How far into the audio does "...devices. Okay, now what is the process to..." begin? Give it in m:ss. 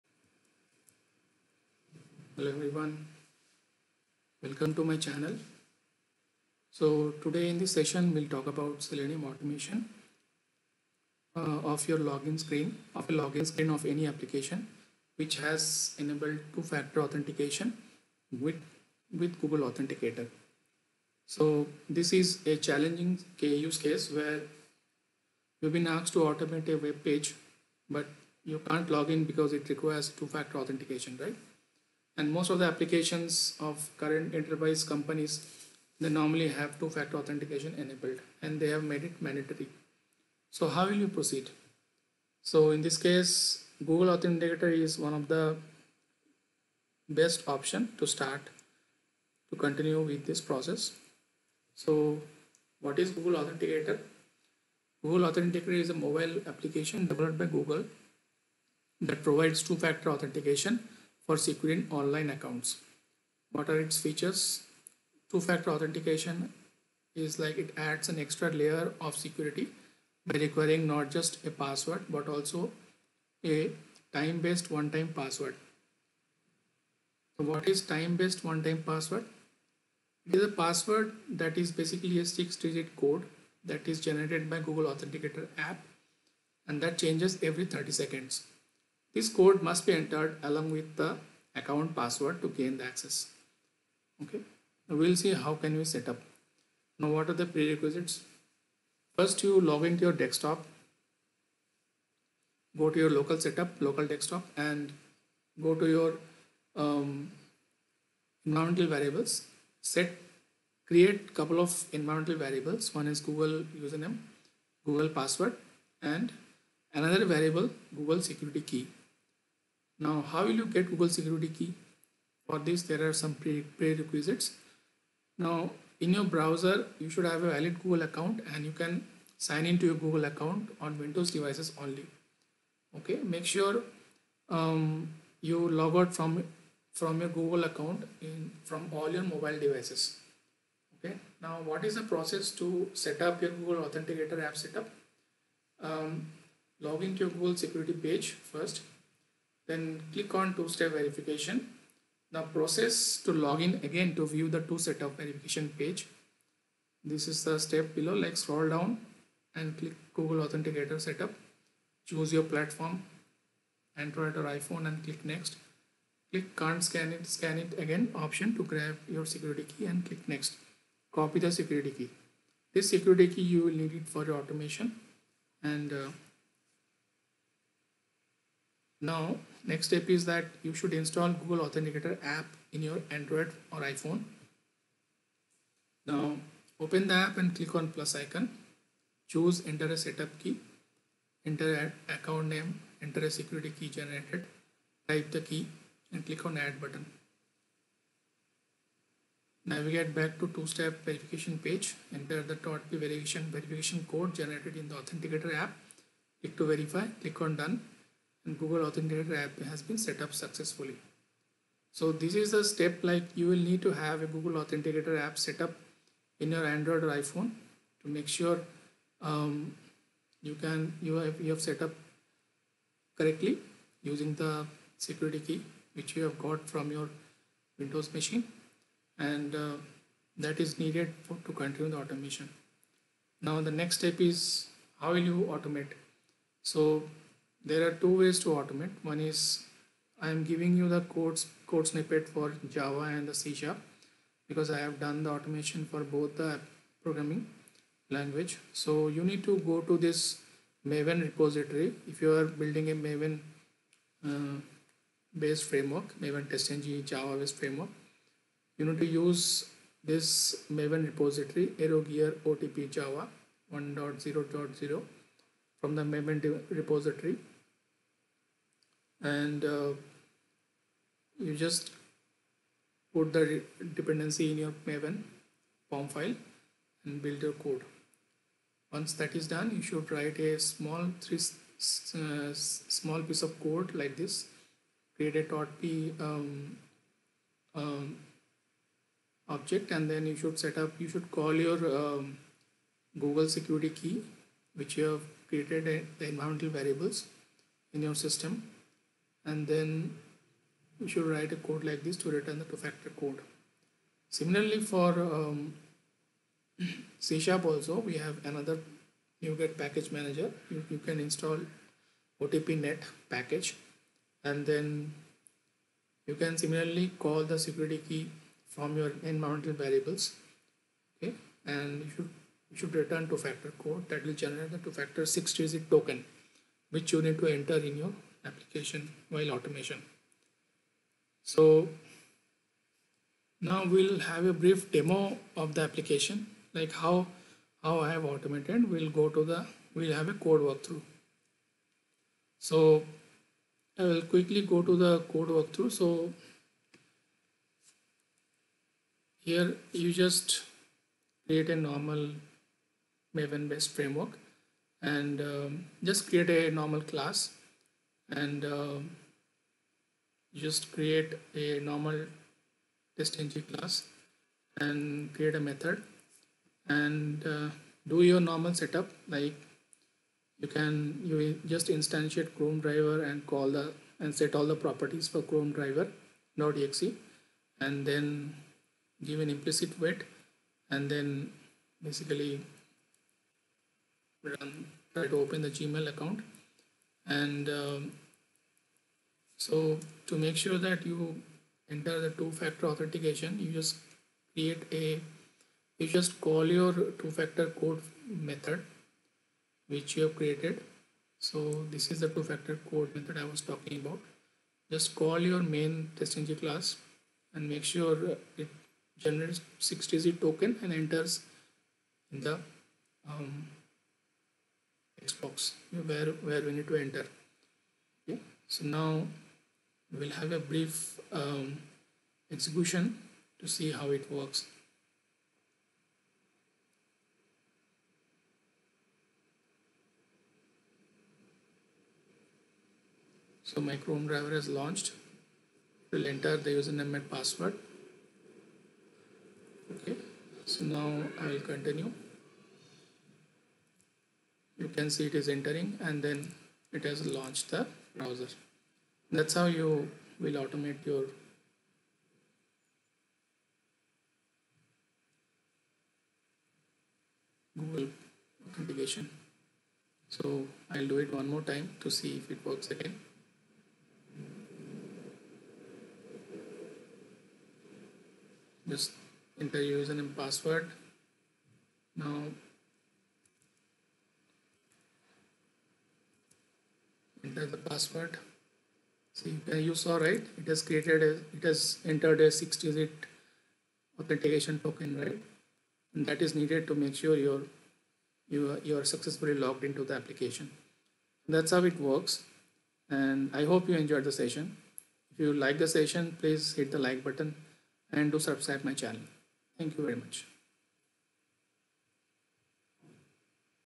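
2:19.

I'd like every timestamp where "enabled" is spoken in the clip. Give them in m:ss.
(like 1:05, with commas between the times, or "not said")
0:15, 0:37.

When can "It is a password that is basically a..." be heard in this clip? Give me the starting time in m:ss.
1:20.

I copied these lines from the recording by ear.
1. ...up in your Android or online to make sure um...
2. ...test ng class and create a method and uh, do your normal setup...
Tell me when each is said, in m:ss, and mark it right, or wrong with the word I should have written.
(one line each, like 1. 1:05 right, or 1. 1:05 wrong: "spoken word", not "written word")
1. 3:35 wrong: "iPhone", not "online"
2. 6:03 right.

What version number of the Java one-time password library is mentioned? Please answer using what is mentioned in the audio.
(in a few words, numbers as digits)
1.0.0.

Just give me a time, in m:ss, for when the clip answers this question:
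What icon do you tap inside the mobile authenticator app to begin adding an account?
3:07.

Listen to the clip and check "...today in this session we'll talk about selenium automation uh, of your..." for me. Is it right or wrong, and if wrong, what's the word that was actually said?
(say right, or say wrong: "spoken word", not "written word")
right.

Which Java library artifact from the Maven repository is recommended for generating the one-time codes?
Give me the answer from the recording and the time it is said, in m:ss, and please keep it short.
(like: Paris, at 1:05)
aerogear otp java, at 4:21.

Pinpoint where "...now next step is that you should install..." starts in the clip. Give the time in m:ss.
2:59.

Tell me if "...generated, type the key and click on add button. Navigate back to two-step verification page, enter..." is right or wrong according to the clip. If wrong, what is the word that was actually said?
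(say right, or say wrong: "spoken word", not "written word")
right.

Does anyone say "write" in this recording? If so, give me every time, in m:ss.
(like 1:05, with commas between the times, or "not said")
4:40, 5:01.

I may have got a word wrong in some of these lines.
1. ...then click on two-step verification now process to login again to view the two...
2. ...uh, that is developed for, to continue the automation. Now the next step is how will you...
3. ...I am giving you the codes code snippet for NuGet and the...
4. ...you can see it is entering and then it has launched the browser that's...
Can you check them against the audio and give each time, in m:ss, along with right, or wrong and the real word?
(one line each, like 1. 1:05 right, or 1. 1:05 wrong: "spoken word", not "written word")
1. 2:29 right
2. 3:49 wrong: "needed", not "developed"
3. 4:00 wrong: "Java", not "NuGet"
4. 7:24 right.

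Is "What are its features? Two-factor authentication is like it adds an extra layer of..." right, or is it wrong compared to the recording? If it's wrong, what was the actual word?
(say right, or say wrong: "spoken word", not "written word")
right.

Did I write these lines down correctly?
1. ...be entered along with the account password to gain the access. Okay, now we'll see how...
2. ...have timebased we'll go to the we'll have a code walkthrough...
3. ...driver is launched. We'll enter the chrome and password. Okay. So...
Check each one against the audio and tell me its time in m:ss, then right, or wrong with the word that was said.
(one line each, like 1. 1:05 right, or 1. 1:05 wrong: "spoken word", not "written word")
1. 1:29 right
2. 5:38 wrong: "automated", not "timebased"
3. 7:14 wrong: "username", not "chrome".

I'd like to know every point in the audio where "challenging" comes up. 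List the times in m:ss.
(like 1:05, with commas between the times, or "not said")
0:22.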